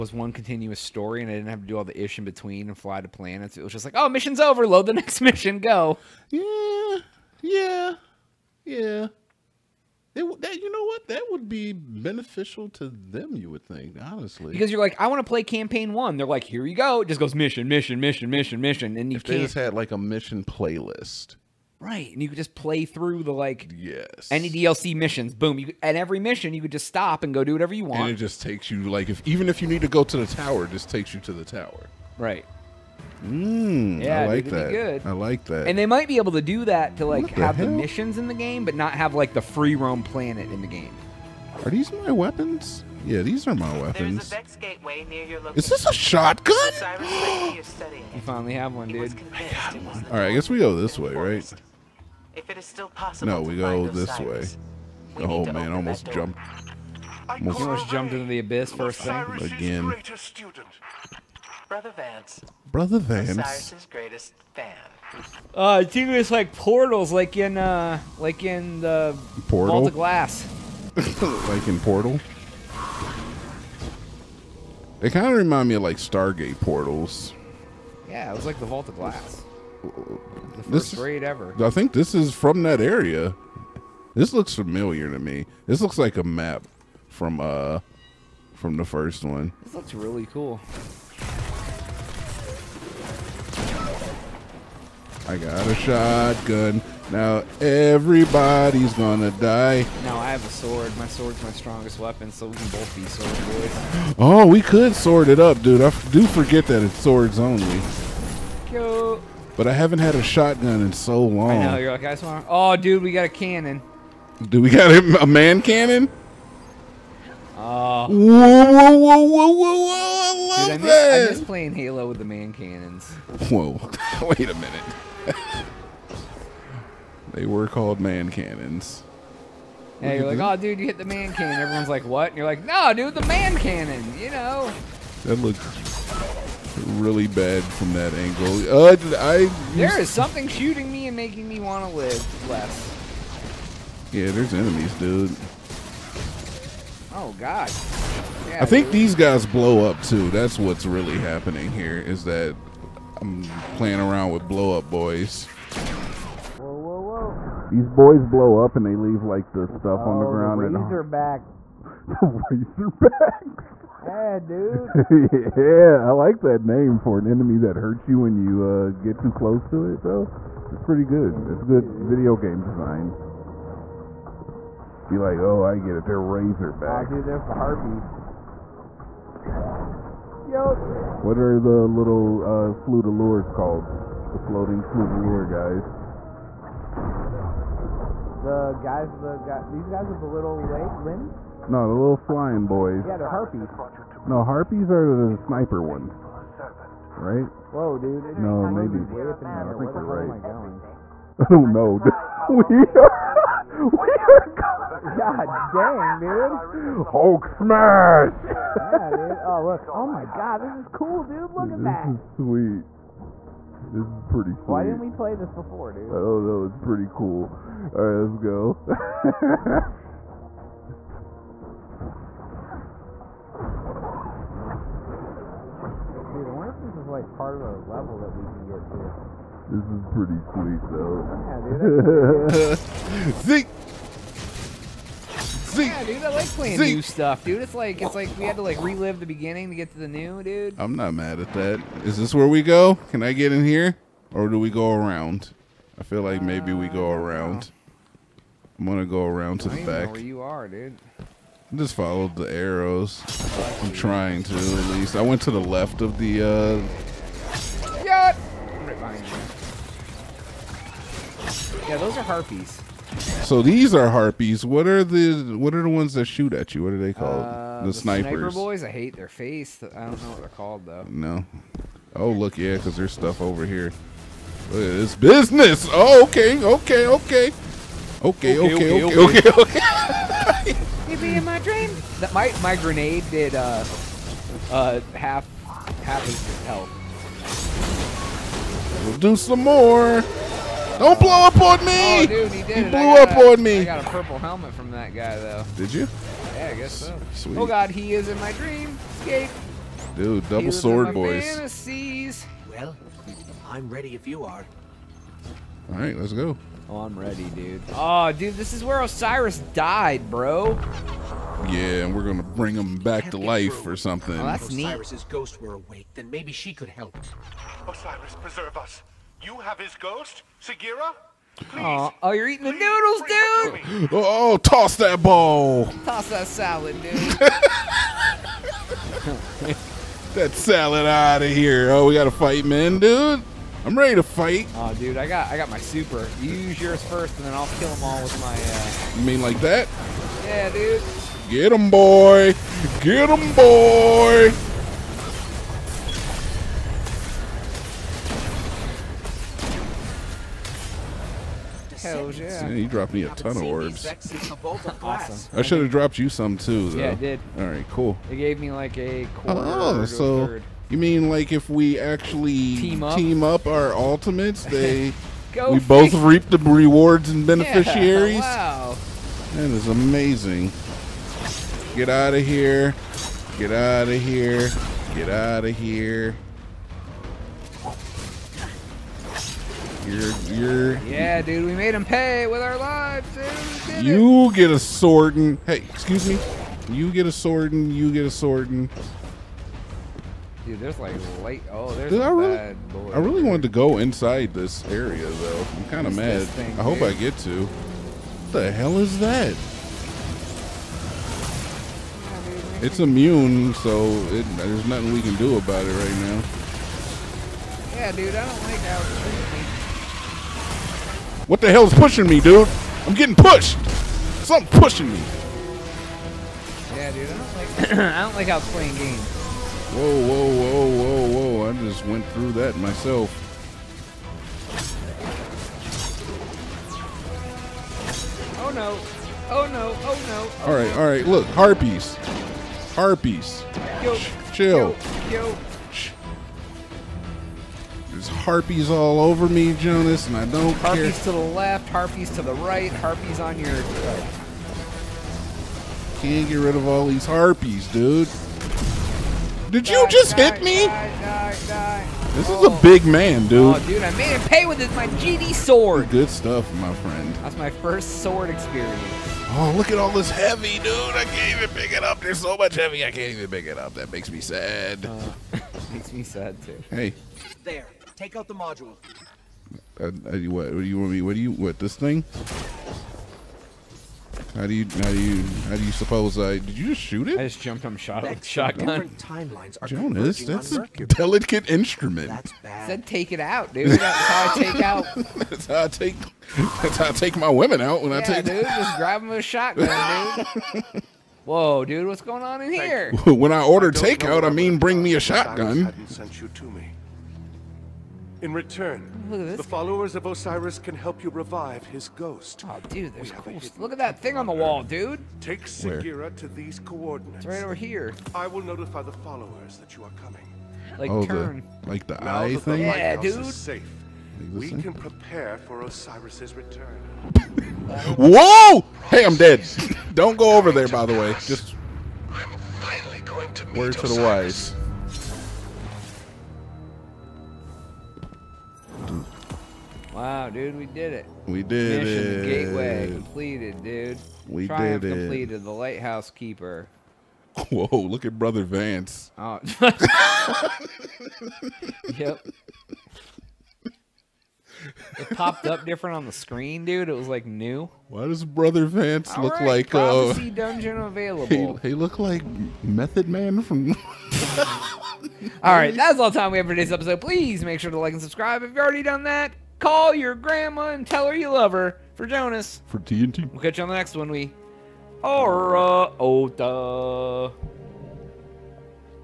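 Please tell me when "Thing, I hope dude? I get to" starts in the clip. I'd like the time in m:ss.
6:36.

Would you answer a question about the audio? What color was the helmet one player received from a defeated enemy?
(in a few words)
Purple.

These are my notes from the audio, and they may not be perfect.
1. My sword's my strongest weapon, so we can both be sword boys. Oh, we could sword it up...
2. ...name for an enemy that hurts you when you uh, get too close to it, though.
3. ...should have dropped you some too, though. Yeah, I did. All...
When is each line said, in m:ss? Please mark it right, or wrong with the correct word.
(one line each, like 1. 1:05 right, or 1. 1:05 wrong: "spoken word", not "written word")
1. 1:40 right
2. 2:46 right
3. 5:55 right.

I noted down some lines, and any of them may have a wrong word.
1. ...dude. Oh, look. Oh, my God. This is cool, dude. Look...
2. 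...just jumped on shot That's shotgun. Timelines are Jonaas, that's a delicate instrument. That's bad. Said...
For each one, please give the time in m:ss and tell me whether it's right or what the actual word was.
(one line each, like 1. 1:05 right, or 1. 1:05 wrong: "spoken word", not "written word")
1. 3:29 right
2. 7:57 right.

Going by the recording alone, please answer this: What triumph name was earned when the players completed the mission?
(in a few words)
The Lighthouse Keeper.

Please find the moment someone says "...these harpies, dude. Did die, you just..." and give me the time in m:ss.
7:27.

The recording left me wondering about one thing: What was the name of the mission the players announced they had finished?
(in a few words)
Gateway.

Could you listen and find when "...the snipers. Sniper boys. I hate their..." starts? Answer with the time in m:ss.
4:27.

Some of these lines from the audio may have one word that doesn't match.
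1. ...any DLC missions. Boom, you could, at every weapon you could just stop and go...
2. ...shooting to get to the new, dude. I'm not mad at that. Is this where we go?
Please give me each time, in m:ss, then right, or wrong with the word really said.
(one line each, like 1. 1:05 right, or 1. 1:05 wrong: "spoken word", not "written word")
1. 0:24 wrong: "mission", not "weapon"
2. 3:59 wrong: "beginning", not "shooting".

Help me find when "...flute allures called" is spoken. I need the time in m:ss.
3:02.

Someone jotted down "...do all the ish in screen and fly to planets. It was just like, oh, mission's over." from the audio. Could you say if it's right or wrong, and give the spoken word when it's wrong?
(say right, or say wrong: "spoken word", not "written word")
wrong: "between", not "screen".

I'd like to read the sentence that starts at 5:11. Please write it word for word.
Yeah, and we're gonna bring him back to life or something.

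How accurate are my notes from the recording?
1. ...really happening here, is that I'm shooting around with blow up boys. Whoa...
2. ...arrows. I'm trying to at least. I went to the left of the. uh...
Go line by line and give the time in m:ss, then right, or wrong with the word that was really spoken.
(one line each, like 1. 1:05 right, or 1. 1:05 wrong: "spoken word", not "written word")
1. 2:30 wrong: "playing", not "shooting"
2. 4:12 right.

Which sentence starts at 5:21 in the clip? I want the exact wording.
Oh, oh, you're eating the noodles, dude!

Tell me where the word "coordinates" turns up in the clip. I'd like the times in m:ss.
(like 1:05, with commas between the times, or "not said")
8:26.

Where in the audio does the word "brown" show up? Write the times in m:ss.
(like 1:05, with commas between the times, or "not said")
not said.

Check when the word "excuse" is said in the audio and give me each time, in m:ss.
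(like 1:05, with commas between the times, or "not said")
6:25.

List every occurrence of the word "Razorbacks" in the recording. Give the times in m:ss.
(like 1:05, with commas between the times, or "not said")
2:42, 2:56.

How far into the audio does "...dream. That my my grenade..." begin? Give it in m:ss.
4:41.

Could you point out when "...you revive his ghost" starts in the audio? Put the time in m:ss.
8:21.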